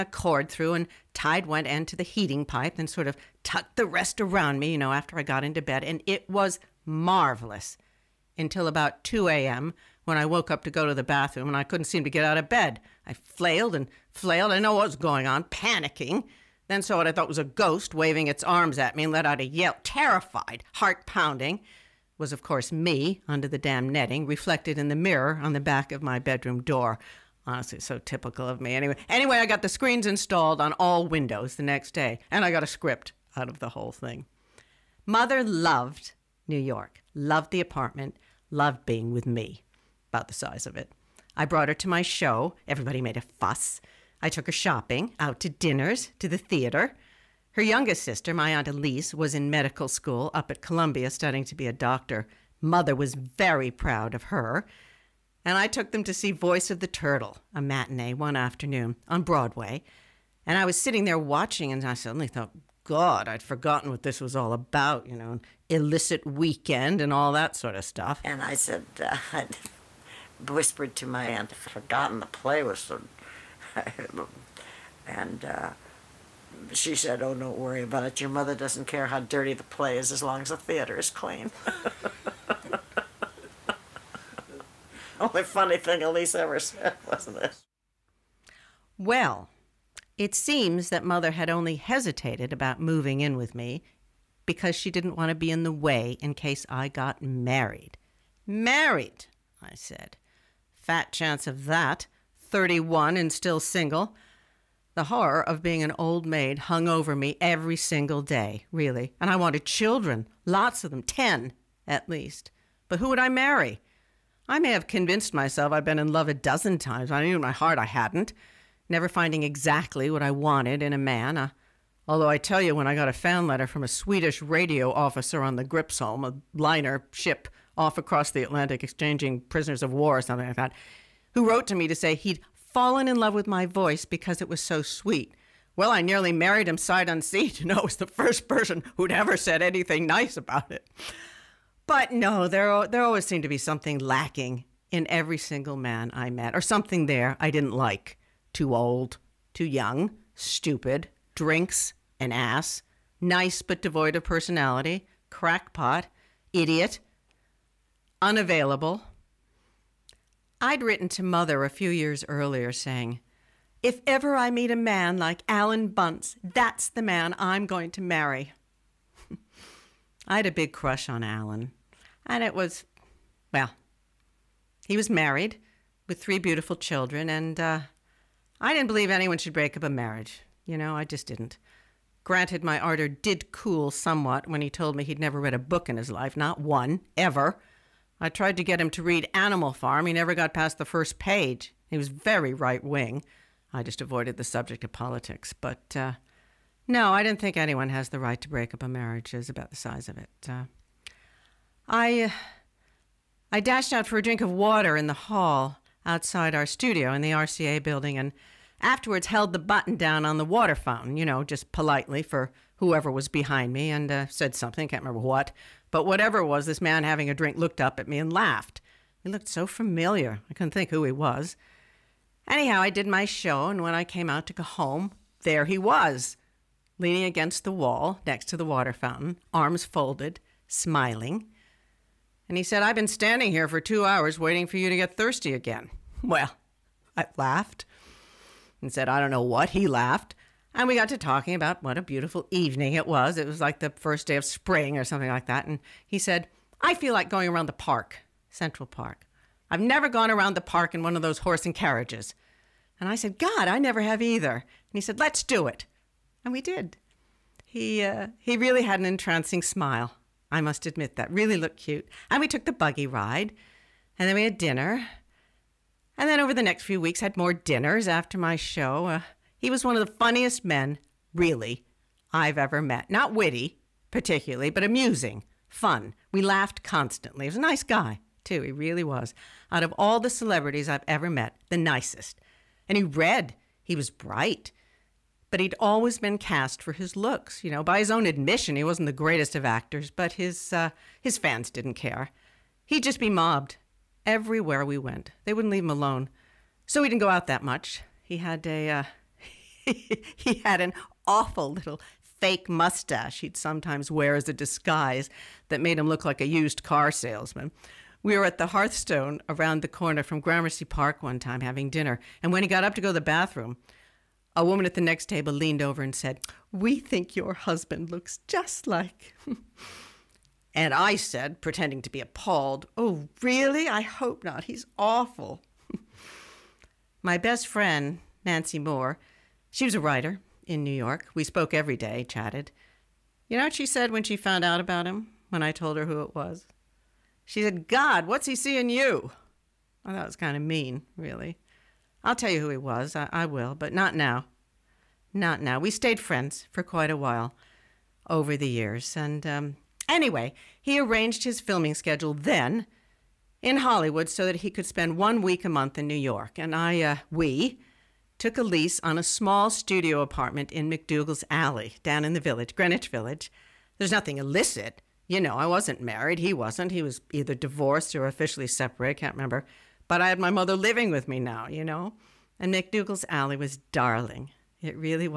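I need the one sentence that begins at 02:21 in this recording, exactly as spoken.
But no, there, there always seemed to be something lacking in every single man I met, or something there I didn't like.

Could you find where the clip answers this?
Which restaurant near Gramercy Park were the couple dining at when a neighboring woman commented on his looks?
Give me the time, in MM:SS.
05:08.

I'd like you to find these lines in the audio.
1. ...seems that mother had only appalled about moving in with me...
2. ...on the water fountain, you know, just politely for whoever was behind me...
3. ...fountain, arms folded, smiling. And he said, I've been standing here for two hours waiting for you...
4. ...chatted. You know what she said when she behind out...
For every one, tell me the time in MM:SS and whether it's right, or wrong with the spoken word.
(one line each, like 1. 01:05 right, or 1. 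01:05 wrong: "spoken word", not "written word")
1. 01:30 wrong: "hesitated", not "appalled"
2. 03:30 right
3. 03:48 right
4. 05:32 wrong: "found", not "behind".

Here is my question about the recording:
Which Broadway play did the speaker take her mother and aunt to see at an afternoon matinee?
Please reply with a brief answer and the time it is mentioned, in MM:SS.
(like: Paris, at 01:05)
Voice of the Turtle, at 00:56.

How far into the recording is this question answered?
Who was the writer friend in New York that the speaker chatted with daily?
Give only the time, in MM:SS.
05:28.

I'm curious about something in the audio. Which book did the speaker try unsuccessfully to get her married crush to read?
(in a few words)
Animal Farm.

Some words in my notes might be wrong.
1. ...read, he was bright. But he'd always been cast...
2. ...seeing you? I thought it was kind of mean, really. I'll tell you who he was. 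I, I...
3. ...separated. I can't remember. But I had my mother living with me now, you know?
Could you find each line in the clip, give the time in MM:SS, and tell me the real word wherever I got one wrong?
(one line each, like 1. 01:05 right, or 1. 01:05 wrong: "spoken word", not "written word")
1. 04:43 right
2. 05:38 right
3. 06:08 right.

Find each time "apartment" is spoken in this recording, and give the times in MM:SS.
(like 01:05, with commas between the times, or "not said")
00:37, 06:00.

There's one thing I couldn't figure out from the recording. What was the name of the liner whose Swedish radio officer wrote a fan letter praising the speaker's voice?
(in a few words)
Gripsholm.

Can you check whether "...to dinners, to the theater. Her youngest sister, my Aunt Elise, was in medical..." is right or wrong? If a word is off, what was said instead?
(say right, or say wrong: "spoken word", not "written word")
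right.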